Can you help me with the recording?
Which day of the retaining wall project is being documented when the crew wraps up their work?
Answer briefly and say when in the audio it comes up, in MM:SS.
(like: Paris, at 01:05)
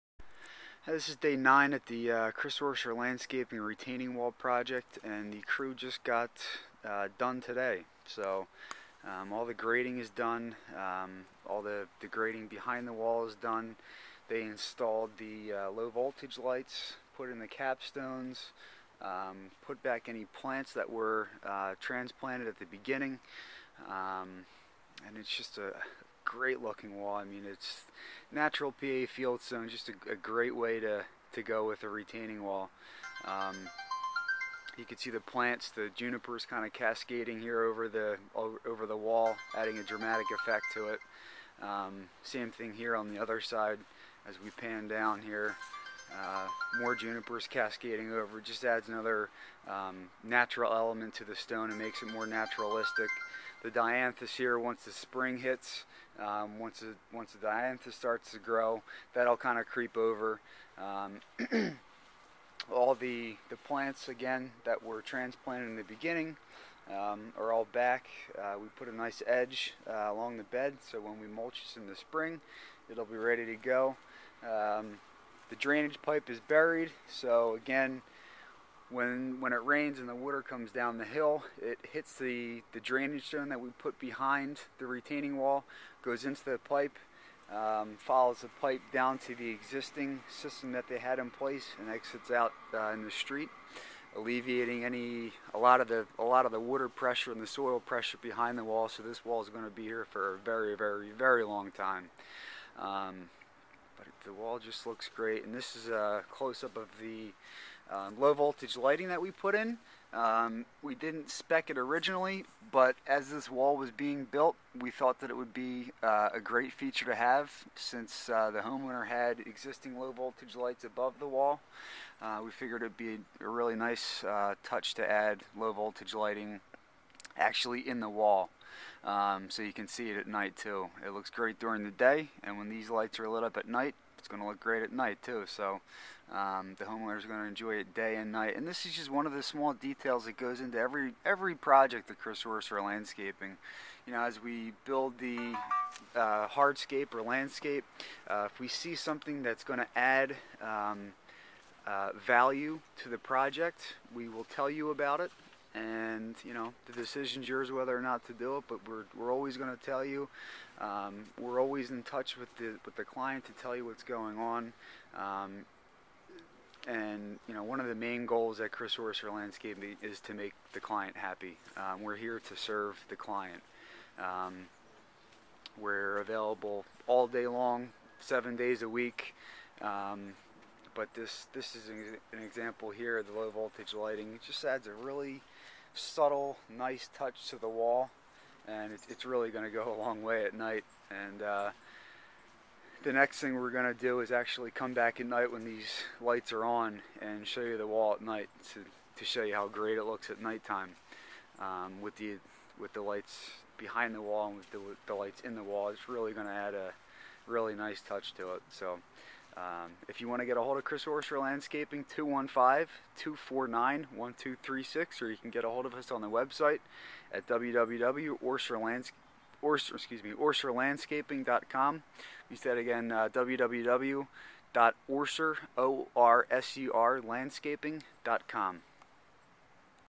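Day 9, at 00:01.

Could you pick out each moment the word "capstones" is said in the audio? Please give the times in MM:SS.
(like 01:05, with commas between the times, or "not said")
00:17.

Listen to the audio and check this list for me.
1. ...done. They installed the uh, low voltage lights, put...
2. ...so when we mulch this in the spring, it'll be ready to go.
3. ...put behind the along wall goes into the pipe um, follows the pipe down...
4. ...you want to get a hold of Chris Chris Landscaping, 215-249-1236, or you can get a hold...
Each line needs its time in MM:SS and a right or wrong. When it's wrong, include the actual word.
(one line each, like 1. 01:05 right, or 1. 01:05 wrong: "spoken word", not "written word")
1. 00:13 right
2. 01:10 right
3. 01:23 wrong: "retaining", not "along"
4. 03:30 wrong: "Orser", not "Chris".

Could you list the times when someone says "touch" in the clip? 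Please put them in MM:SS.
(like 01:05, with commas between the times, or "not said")
02:04, 02:42, 03:07, 03:28.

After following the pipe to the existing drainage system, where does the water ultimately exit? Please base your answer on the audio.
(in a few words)
in the street.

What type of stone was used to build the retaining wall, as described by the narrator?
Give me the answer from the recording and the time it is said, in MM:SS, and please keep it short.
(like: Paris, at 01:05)
natural PA fieldstone, at 00:28.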